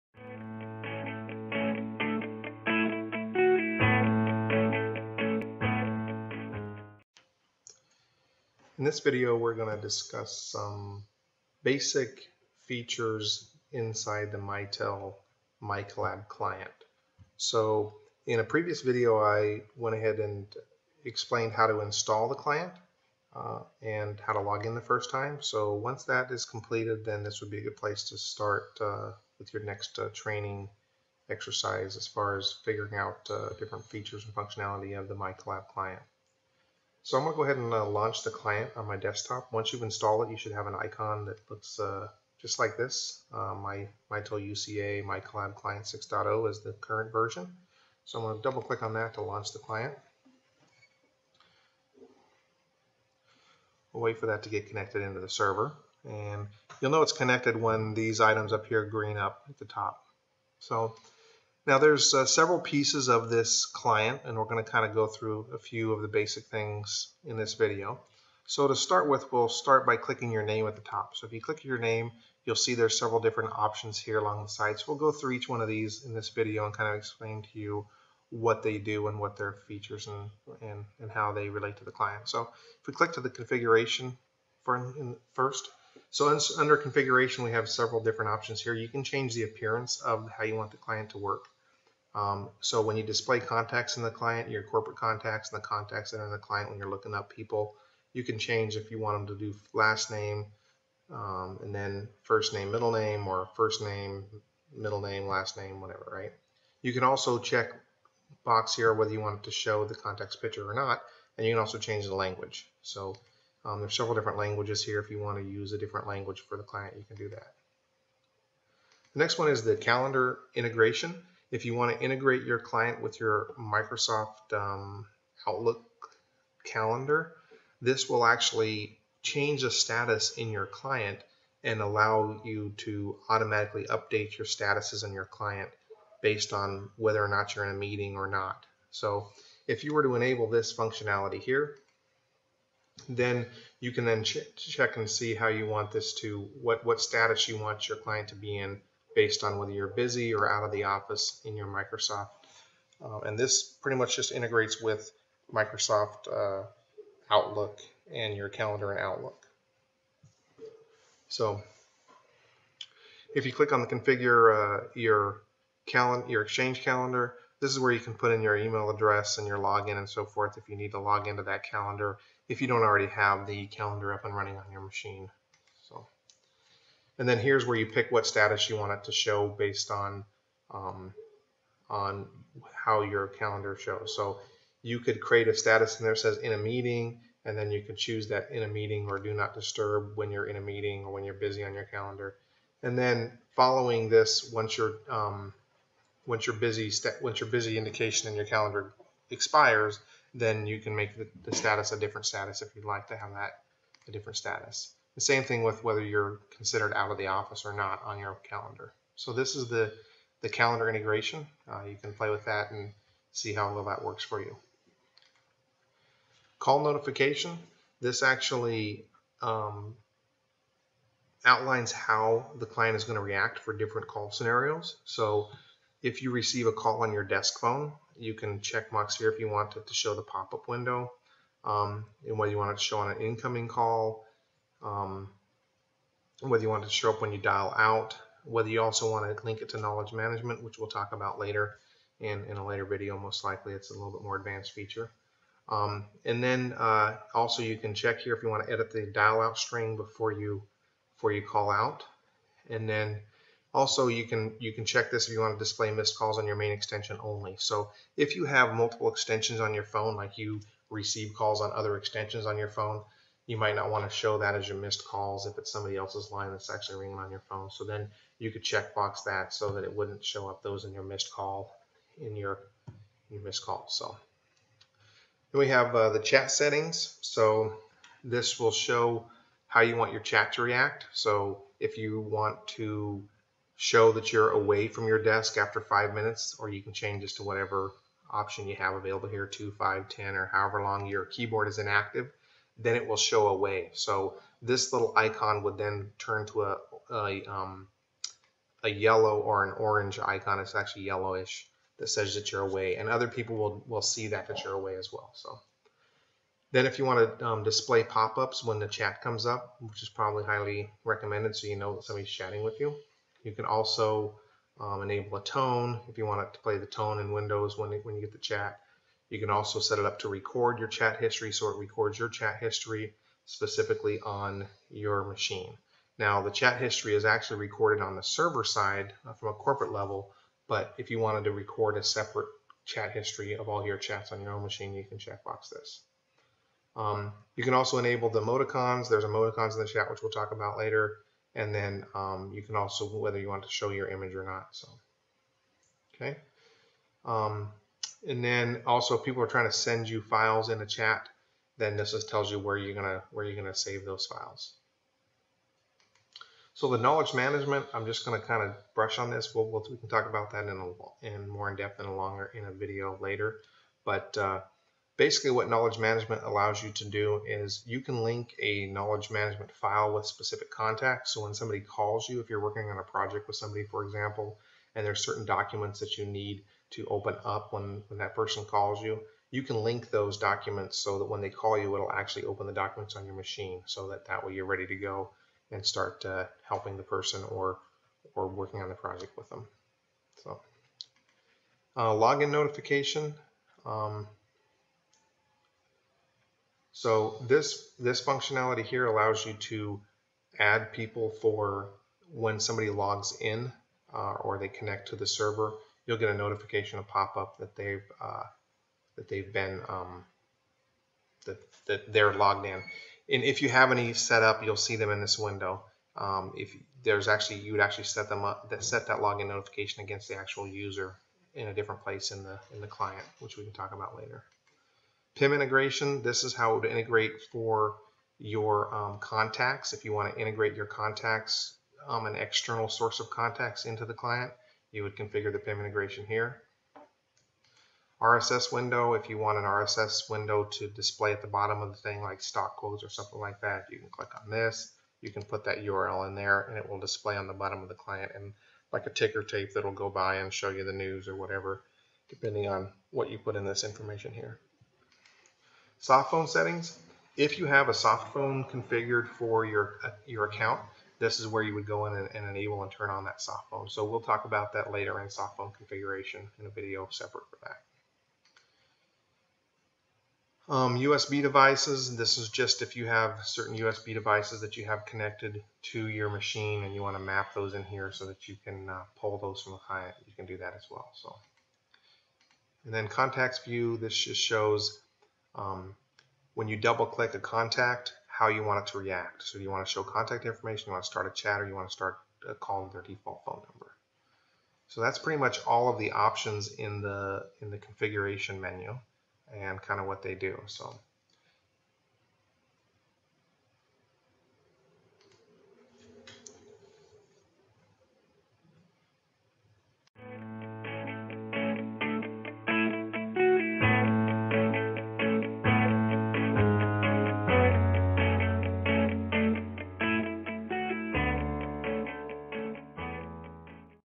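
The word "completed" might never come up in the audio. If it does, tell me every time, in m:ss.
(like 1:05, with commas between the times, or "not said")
0:26.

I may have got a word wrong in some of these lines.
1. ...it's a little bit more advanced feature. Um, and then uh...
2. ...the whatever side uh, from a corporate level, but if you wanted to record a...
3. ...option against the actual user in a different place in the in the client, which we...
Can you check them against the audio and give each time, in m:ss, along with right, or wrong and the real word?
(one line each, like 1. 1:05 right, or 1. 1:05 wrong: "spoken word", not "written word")
1. 4:03 right
2. 5:28 wrong: "server", not "whatever"
3. 6:59 wrong: "notification", not "option".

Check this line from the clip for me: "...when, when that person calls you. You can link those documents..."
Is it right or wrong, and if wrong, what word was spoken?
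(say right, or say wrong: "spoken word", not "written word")
right.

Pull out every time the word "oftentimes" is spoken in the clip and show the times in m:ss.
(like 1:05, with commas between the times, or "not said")
not said.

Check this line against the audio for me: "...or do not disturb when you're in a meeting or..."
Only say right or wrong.
right.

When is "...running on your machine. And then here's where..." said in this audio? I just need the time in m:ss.
2:54.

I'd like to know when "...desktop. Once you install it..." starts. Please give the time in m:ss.
0:38.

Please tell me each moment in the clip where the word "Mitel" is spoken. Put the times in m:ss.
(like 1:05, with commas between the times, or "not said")
0:14, 0:44.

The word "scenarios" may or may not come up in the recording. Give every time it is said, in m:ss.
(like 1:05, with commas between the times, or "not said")
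3:44.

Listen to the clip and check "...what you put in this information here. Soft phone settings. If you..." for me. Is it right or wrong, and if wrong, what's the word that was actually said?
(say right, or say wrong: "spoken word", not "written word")
right.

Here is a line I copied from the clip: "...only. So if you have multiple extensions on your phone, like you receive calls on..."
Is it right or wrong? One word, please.
right.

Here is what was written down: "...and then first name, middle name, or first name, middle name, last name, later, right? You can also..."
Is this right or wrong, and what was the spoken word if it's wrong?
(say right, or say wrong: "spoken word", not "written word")
wrong: "whatever", not "later".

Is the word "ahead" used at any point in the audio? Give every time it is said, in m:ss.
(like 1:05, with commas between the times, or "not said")
0:19, 0:37.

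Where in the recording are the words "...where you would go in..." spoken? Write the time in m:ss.
7:41.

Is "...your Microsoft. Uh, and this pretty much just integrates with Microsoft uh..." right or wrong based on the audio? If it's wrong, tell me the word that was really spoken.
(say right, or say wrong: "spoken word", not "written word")
right.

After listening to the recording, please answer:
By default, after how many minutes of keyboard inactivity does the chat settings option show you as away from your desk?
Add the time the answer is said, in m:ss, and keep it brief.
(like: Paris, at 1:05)
5, at 4:45.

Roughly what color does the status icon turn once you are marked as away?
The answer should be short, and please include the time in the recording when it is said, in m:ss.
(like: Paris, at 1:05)
yellowish, at 5:01.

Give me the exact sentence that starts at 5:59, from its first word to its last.
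We'll, we'll, we can talk about that in a, in more in depth and a longer in a video later.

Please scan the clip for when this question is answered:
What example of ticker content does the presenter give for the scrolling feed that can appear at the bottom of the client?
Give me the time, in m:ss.
7:22.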